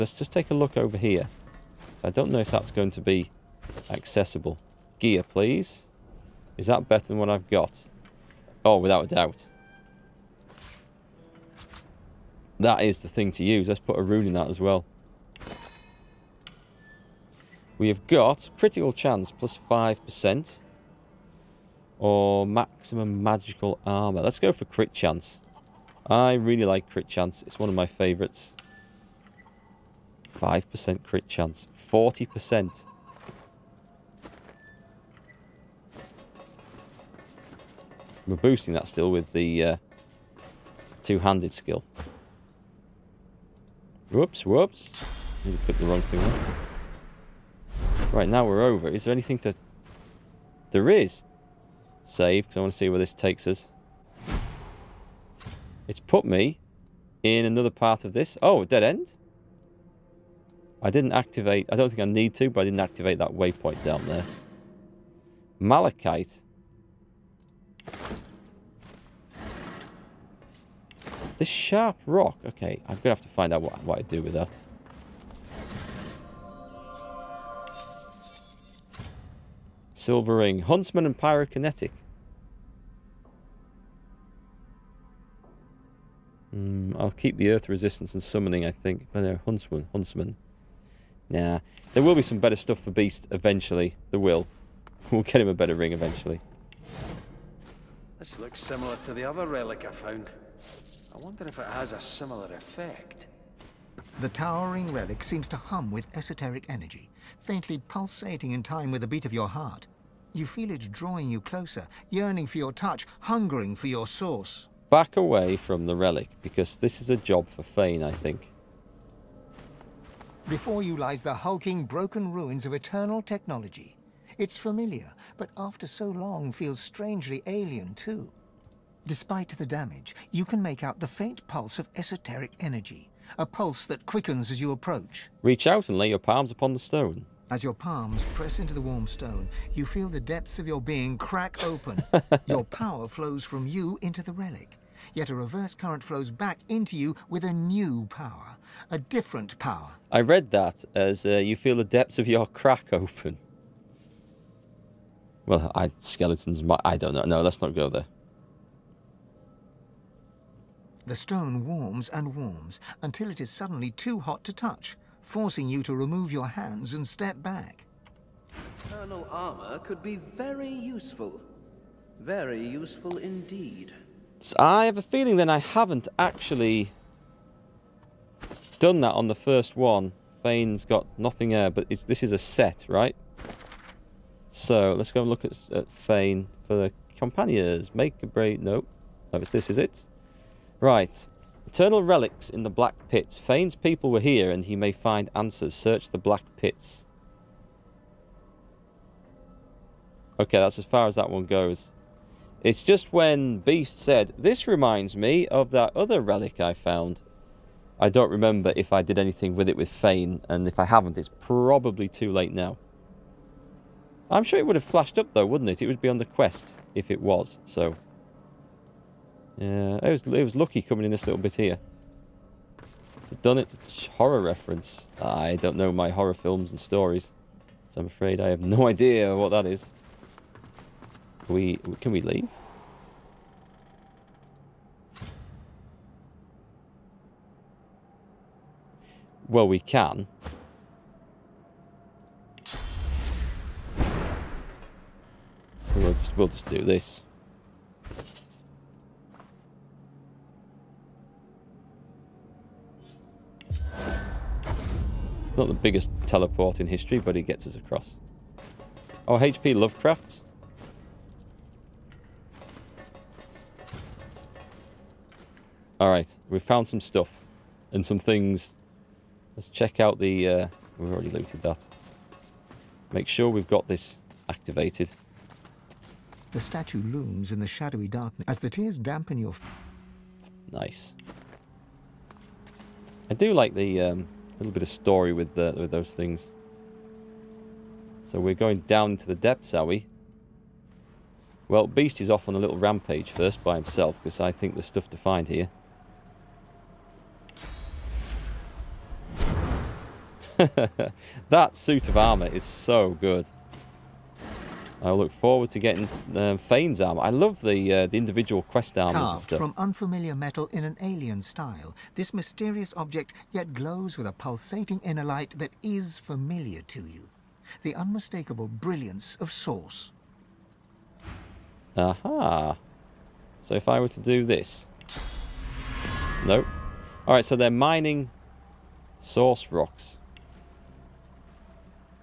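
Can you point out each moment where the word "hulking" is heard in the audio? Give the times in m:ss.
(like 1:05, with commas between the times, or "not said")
2:01.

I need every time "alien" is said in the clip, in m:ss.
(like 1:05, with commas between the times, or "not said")
2:07, 5:10.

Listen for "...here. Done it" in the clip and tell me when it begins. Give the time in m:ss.
3:41.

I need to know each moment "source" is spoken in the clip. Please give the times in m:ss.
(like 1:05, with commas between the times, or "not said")
1:54, 5:19, 5:29.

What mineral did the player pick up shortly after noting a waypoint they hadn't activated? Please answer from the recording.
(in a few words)
Malachite.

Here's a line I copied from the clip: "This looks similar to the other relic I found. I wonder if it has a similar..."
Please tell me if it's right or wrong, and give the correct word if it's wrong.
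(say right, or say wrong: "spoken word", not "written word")
right.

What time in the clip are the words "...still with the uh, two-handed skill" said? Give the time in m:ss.
0:38.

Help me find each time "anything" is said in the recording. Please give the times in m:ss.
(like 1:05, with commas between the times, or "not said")
0:49, 3:29.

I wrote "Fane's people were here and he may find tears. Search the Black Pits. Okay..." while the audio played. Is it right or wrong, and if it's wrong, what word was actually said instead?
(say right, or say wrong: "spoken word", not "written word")
wrong: "answers", not "tears".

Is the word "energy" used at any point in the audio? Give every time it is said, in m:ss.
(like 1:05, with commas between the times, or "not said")
1:46, 2:12.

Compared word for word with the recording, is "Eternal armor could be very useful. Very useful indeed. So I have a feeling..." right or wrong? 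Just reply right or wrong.
right.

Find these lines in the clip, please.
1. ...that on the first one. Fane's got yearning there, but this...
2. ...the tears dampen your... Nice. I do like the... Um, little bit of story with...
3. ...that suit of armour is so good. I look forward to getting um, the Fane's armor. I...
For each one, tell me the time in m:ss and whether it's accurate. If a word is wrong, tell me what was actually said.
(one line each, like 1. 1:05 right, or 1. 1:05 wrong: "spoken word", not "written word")
1. 2:58 wrong: "nothing", not "yearning"
2. 4:38 right
3. 5:01 right.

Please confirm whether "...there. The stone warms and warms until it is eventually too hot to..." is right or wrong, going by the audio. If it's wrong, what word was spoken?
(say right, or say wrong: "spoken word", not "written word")
wrong: "suddenly", not "eventually".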